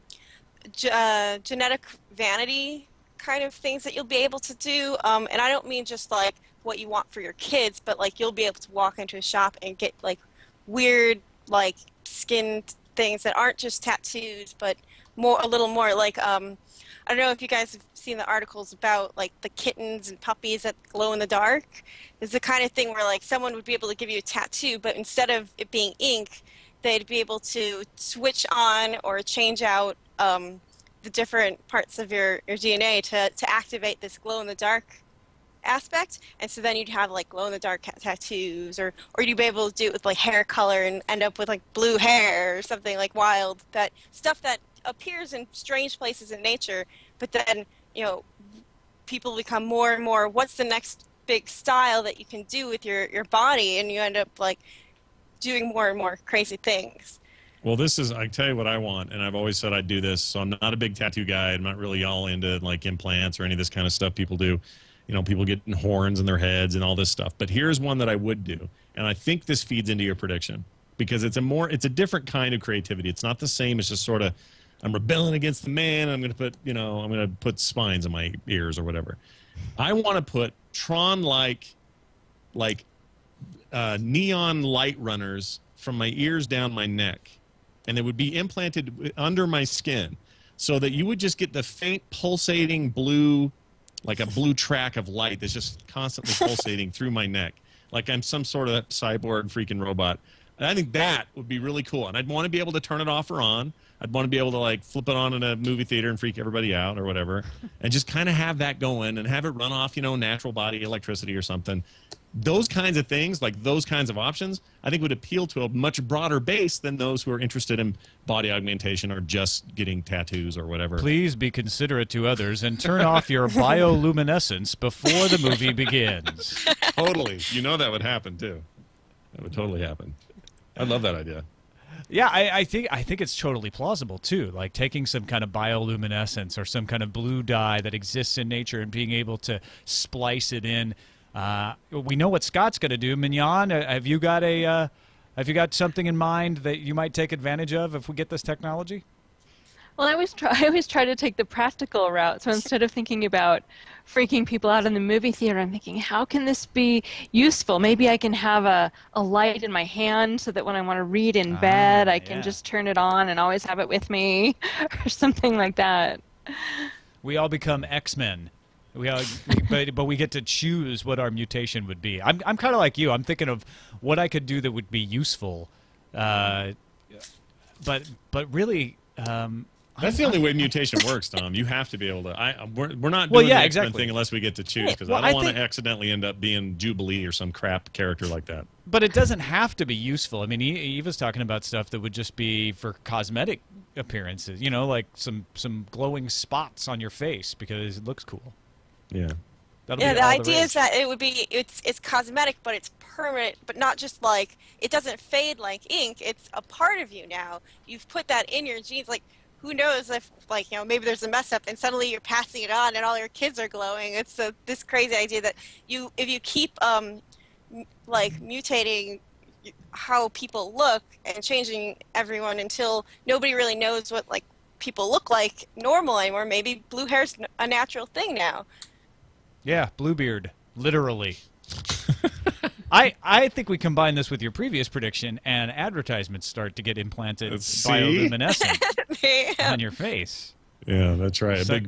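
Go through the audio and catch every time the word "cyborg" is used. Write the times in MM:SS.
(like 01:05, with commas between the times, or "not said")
01:38.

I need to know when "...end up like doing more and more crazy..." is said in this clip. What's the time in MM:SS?
00:53.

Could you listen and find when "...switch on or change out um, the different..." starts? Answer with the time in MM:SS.
00:27.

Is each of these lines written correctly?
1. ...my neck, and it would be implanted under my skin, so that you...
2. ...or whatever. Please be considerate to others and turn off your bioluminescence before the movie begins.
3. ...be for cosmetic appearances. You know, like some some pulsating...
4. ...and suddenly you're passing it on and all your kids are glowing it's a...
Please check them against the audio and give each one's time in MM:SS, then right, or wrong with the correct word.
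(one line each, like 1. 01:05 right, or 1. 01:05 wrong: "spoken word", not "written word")
1. 01:26 right
2. 02:00 right
3. 03:12 wrong: "glowing", not "pulsating"
4. 03:31 right.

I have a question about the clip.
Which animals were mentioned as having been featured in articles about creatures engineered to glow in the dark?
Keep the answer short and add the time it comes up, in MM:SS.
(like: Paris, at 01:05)
kittens and puppies, at 00:19.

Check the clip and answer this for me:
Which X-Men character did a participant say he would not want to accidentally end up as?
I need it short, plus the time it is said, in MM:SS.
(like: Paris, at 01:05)
Jubilee, at 03:06.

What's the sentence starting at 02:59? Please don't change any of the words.
Um, that's the only way mutation works, Tom.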